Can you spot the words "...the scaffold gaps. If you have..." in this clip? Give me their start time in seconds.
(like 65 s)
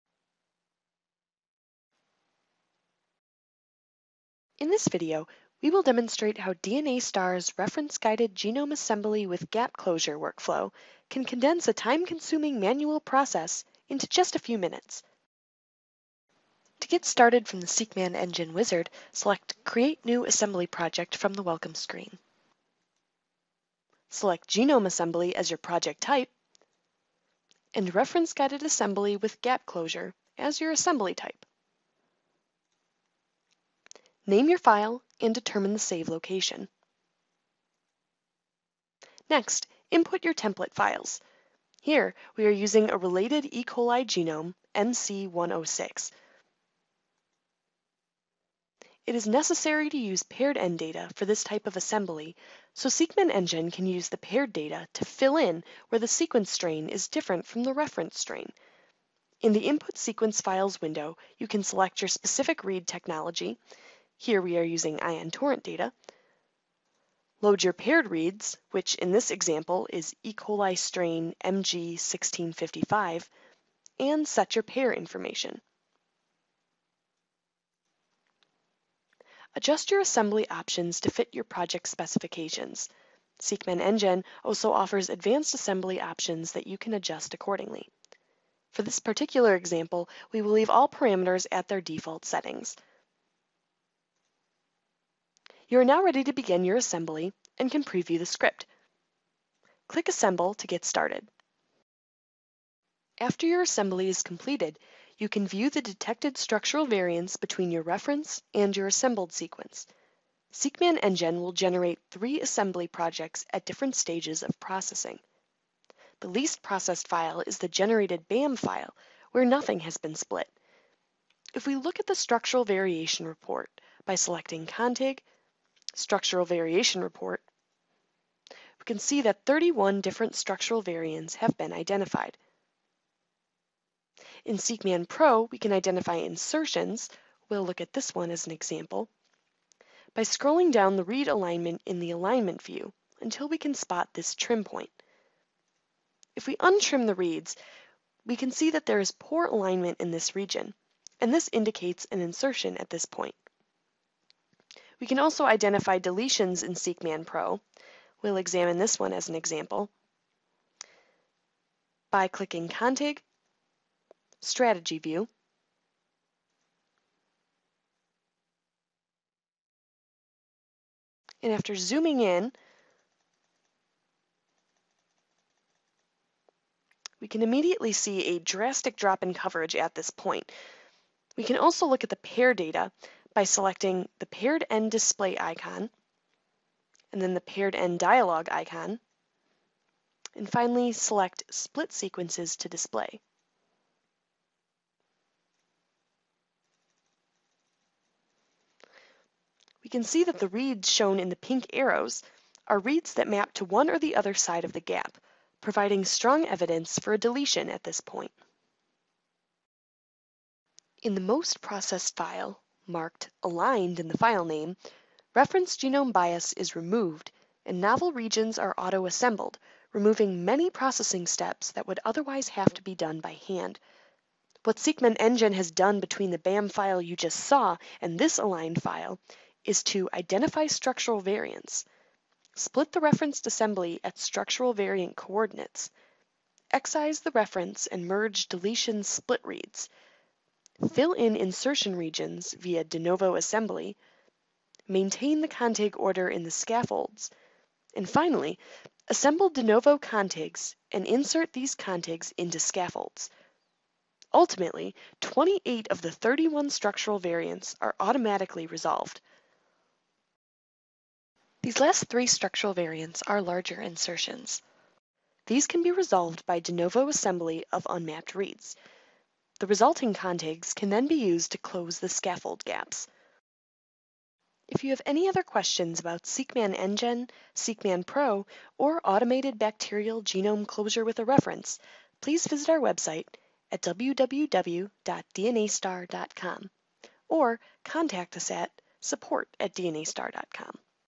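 271 s.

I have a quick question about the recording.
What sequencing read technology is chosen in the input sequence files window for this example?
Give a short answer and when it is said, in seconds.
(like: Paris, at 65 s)
Ion Torrent, at 65 s.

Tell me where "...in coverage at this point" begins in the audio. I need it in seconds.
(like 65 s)
179 s.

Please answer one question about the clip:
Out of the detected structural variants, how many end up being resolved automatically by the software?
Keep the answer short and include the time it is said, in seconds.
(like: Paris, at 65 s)
28, at 255 s.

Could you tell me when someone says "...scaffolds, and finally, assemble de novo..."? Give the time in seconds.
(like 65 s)
246 s.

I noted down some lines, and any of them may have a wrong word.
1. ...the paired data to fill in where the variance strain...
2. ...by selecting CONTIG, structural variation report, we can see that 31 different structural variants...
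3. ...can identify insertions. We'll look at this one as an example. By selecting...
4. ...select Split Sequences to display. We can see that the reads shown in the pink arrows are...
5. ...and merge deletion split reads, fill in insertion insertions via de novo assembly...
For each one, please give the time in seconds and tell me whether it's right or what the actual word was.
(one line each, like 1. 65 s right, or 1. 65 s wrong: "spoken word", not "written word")
1. 54 s wrong: "sequence", not "variance"
2. 124 s right
3. 135 s wrong: "scrolling", not "selecting"
4. 190 s right
5. 237 s wrong: "regions", not "insertions".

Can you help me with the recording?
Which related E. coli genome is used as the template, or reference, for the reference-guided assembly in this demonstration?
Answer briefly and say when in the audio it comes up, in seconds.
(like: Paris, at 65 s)
MC106, at 44 s.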